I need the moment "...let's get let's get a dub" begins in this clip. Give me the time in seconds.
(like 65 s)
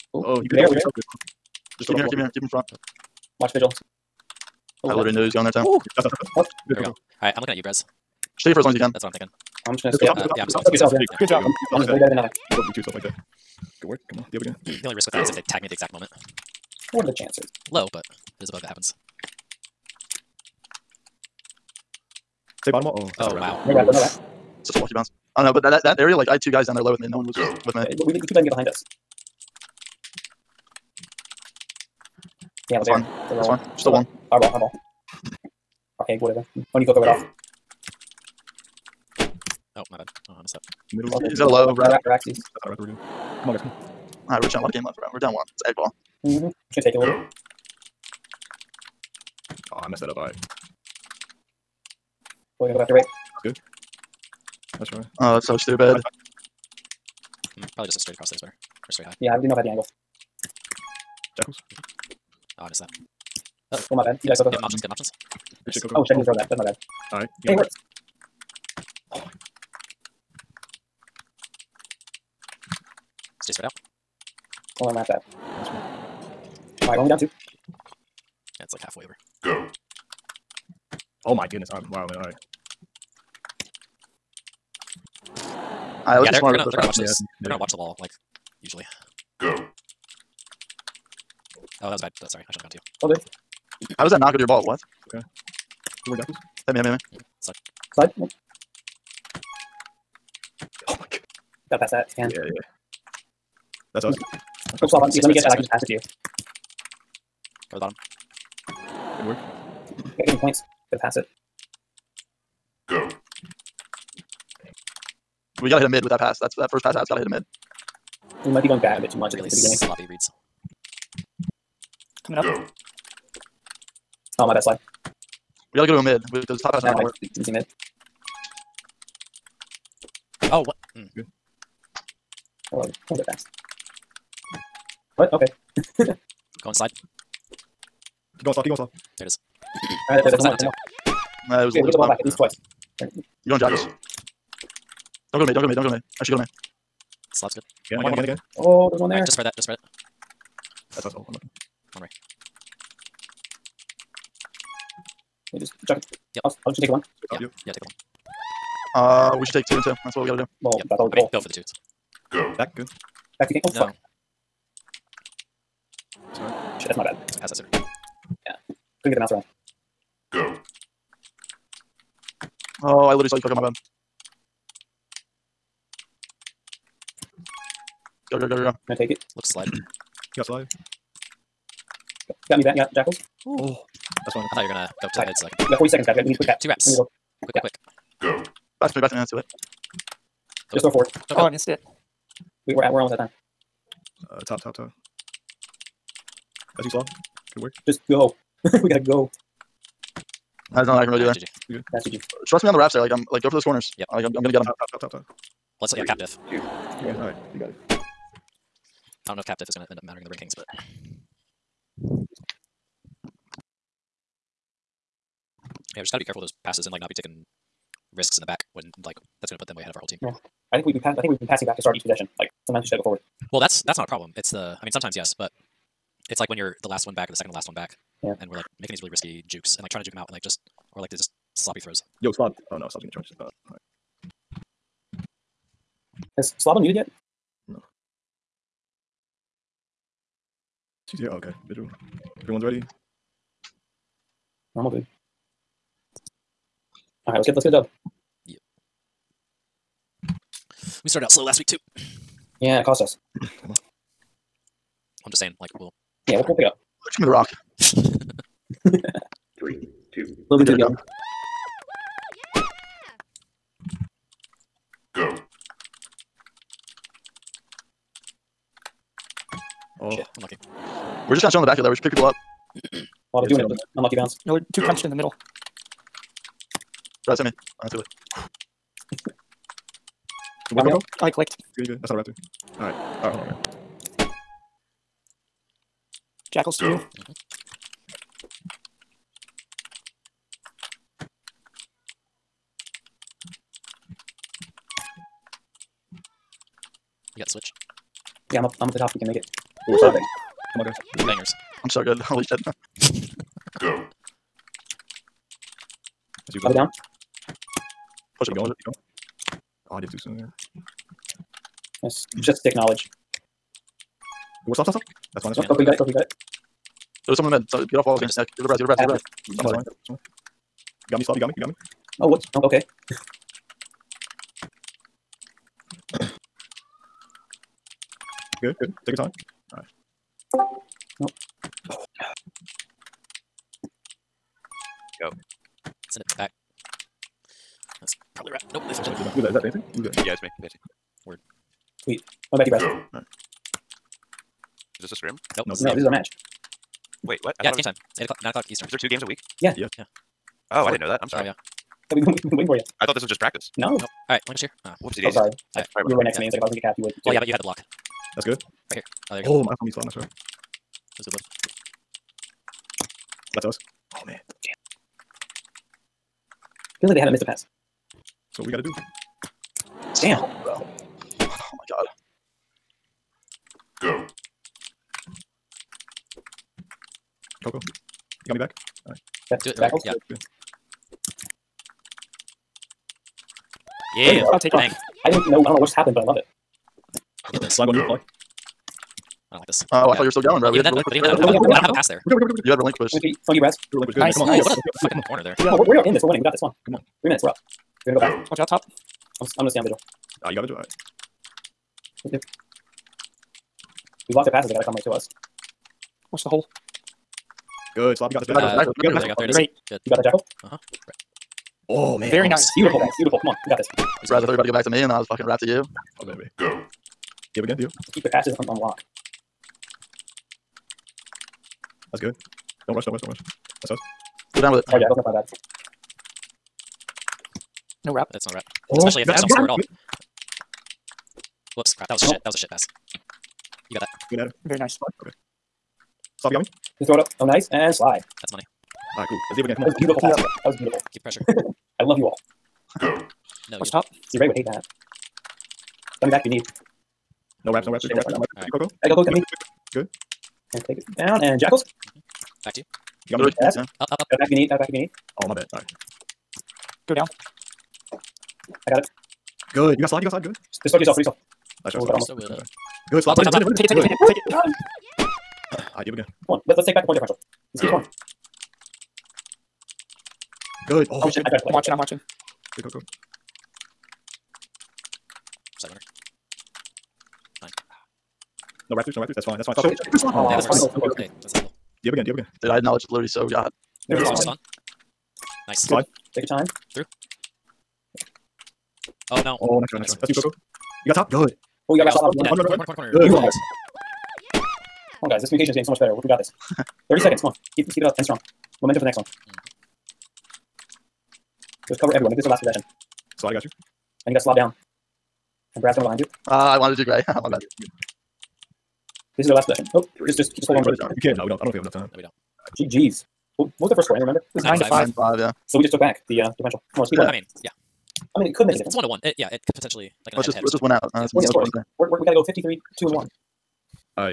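247 s.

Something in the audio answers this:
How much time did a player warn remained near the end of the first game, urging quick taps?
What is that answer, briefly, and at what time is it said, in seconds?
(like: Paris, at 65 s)
40 seconds, at 185 s.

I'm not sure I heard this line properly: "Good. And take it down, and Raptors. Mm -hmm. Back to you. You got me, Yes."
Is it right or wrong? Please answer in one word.
wrong.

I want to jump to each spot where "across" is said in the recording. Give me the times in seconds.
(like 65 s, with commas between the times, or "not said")
58 s.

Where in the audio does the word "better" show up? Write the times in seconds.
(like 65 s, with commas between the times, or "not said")
11 s, 58 s, 495 s.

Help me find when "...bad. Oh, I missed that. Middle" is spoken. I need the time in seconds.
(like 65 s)
39 s.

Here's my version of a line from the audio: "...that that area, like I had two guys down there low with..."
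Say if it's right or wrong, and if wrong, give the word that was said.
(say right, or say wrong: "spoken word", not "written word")
right.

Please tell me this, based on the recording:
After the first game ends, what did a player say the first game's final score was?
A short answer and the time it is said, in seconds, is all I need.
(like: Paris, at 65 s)
9 to 5, at 514 s.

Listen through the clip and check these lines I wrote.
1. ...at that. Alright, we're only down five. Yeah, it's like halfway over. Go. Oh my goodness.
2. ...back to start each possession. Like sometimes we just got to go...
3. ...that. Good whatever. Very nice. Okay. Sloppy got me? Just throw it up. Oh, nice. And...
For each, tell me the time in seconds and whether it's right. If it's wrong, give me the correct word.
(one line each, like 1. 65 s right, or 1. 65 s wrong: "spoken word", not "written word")
1. 74 s wrong: "two", not "five"
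2. 221 s right
3. 434 s wrong: "adder", not "whatever".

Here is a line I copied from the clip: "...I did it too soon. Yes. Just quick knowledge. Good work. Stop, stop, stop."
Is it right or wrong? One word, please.
wrong.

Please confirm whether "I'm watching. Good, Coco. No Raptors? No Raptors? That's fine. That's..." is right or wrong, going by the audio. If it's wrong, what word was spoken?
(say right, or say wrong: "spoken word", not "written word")
right.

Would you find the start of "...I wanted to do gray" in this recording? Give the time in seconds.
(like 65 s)
506 s.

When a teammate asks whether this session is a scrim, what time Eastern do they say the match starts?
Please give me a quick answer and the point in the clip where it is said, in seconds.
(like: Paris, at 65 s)
9 o'clock, at 348 s.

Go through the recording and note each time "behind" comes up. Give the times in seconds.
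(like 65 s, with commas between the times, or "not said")
28 s, 506 s.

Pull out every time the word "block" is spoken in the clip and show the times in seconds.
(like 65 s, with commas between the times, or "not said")
357 s, 404 s.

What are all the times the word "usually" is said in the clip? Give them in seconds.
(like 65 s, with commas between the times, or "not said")
88 s.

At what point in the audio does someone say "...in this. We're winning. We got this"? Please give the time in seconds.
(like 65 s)
396 s.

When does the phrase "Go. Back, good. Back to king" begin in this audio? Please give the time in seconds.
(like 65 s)
162 s.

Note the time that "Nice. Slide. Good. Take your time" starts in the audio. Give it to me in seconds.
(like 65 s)
485 s.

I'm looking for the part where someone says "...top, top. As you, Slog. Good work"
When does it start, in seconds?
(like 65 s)
194 s.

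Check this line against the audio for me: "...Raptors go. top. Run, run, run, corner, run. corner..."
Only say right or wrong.
right.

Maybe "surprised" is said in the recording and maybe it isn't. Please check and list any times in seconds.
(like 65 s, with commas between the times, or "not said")
414 s.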